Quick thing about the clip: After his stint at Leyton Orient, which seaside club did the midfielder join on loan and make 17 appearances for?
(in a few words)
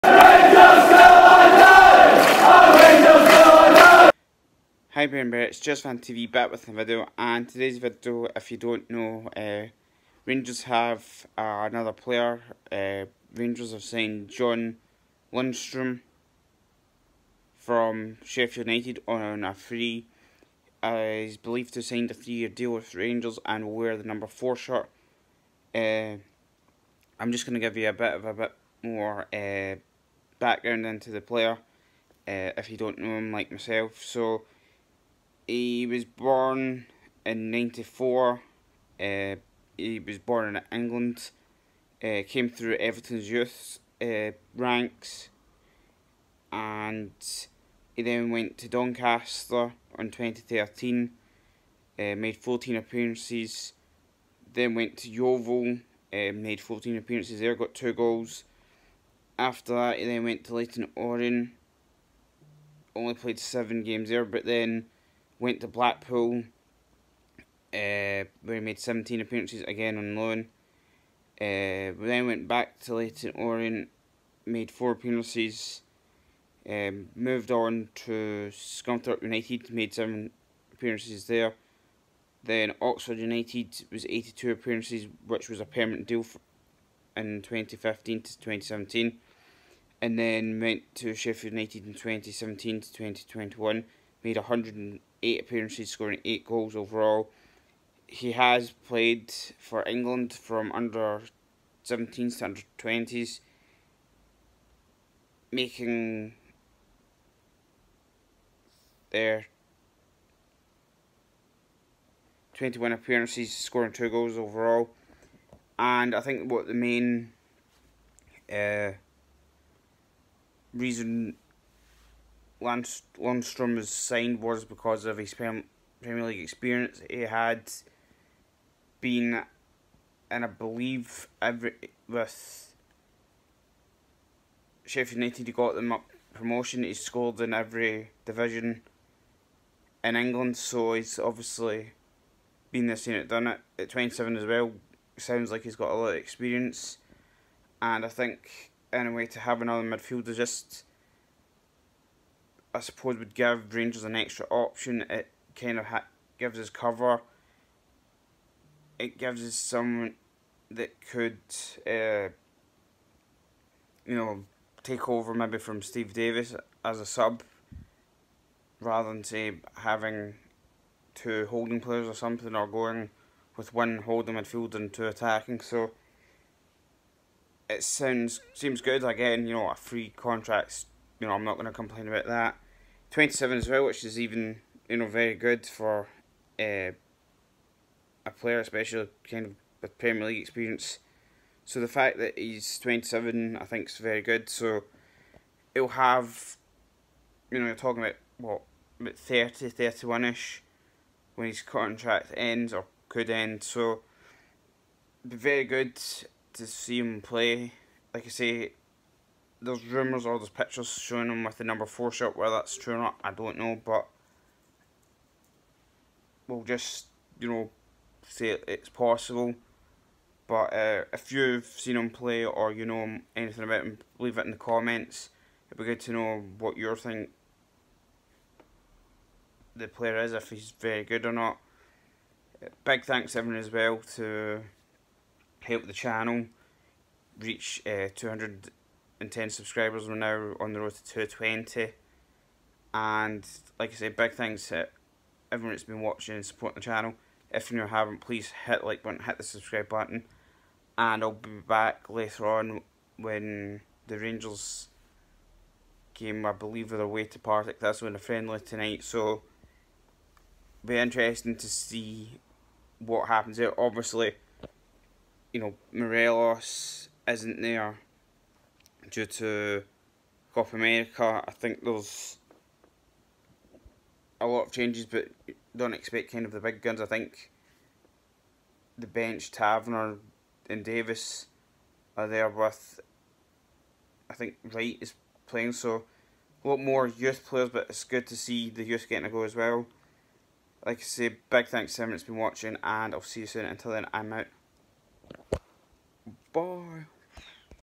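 Blackpool.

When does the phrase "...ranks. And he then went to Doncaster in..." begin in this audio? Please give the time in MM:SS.
00:44.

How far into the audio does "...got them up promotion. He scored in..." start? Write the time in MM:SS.
02:15.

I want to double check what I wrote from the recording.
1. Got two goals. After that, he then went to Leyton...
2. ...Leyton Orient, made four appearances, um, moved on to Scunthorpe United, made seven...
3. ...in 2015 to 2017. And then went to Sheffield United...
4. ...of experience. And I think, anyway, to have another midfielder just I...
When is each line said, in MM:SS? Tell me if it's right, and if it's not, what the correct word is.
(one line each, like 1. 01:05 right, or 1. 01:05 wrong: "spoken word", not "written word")
1. 00:57 right
2. 01:12 right
3. 01:27 right
4. 02:26 right.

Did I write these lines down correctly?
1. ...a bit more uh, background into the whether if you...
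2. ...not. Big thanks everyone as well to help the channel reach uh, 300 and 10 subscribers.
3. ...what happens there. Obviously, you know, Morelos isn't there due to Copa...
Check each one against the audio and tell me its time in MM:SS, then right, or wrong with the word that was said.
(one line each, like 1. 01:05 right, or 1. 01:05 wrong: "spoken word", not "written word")
1. 00:28 wrong: "player", not "whether"
2. 03:51 wrong: "200", not "300"
3. 04:22 right.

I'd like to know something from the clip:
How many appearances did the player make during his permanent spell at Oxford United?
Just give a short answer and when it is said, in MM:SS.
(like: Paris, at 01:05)
82, at 01:24.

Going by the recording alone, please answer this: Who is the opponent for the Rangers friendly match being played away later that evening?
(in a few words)
Partick.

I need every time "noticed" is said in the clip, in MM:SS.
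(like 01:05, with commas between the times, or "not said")
not said.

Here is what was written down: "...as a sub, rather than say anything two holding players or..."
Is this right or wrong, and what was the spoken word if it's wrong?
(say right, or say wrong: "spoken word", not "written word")
wrong: "having", not "anything".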